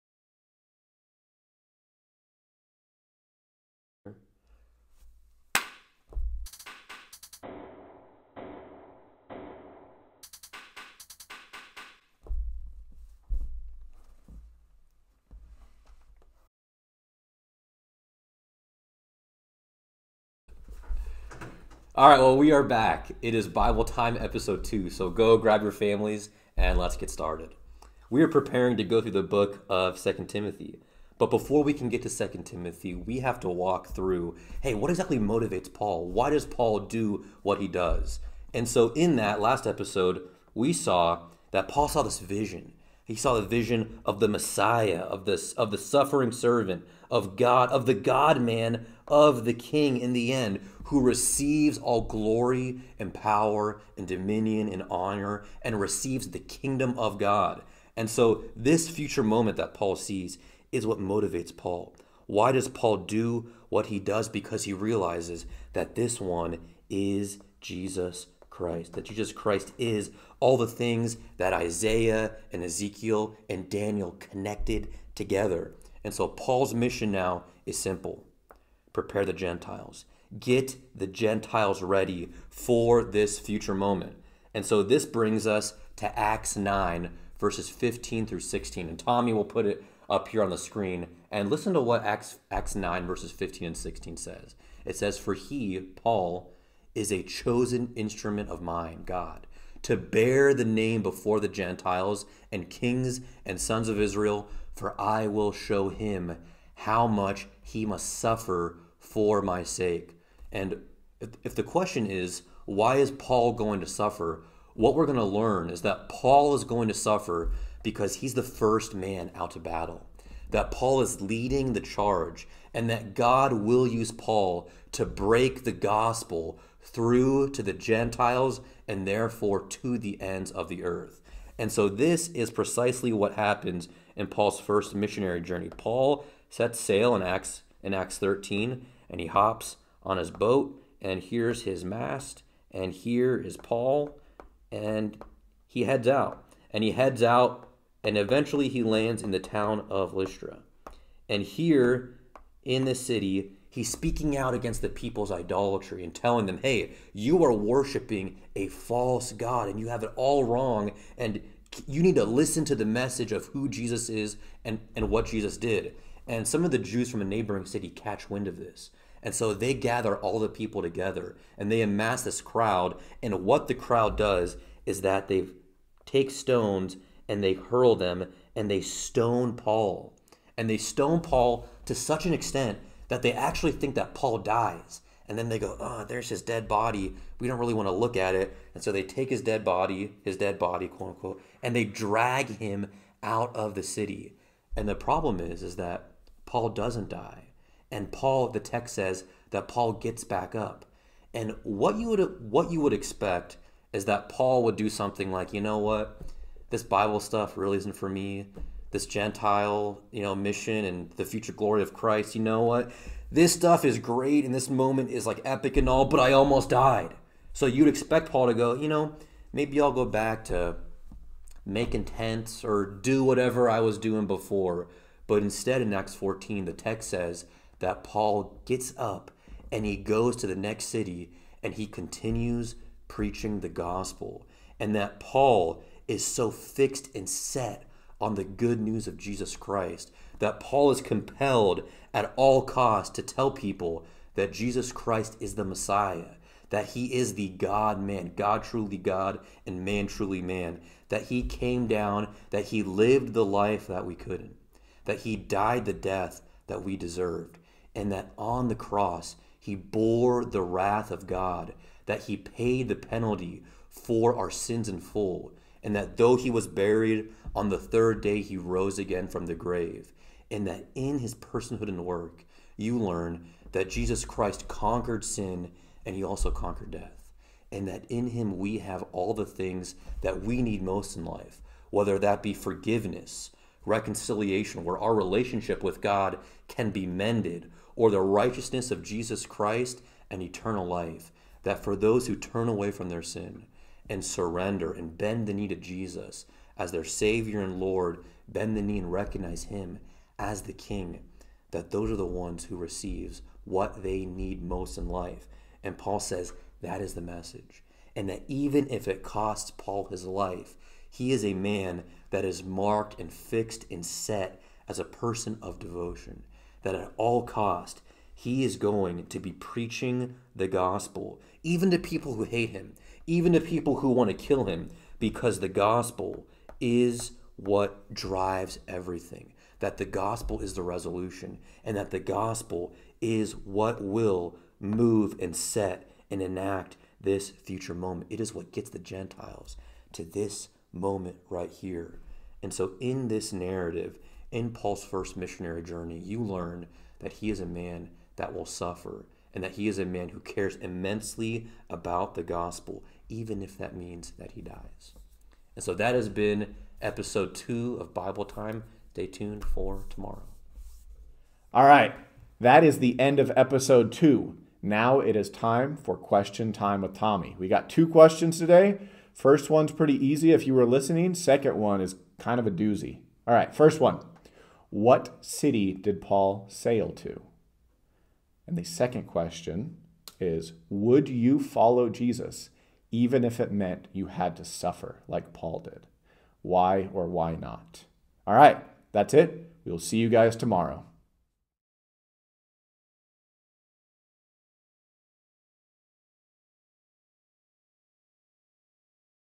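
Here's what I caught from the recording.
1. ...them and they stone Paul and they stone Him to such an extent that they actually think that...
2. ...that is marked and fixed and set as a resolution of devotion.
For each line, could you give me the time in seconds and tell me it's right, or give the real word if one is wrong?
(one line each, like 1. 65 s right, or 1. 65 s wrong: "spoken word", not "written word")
1. 177 s wrong: "Paul", not "Him"
2. 312 s wrong: "person", not "resolution".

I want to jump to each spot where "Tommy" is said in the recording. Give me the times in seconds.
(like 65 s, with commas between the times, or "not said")
88 s, 367 s.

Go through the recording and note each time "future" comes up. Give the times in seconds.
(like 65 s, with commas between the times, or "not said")
58 s, 83 s, 211 s, 337 s.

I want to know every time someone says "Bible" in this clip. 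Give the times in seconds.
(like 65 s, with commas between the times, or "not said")
23 s, 206 s, 358 s.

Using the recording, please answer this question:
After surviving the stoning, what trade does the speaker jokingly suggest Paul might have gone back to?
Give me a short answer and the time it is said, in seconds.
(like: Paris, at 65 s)
Making tents, at 221 s.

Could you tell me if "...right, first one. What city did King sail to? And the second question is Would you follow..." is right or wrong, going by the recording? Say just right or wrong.
wrong.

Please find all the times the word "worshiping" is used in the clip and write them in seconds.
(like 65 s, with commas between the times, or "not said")
157 s.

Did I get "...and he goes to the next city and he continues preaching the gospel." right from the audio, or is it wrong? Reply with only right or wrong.
right.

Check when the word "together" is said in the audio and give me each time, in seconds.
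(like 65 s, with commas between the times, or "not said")
75 s, 170 s.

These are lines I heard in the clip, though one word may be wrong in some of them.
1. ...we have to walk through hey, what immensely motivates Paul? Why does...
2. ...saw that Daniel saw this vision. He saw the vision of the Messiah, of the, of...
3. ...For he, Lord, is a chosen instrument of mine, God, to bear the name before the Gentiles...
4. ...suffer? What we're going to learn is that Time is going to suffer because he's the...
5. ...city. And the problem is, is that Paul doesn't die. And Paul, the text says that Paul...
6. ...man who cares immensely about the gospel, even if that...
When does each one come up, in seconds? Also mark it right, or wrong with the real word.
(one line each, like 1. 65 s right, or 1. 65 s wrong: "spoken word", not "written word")
1. 32 s wrong: "exactly", not "immensely"
2. 40 s wrong: "Paul", not "Daniel"
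3. 95 s wrong: "Paul", not "Lord"
4. 113 s wrong: "Paul", not "Time"
5. 193 s right
6. 350 s right.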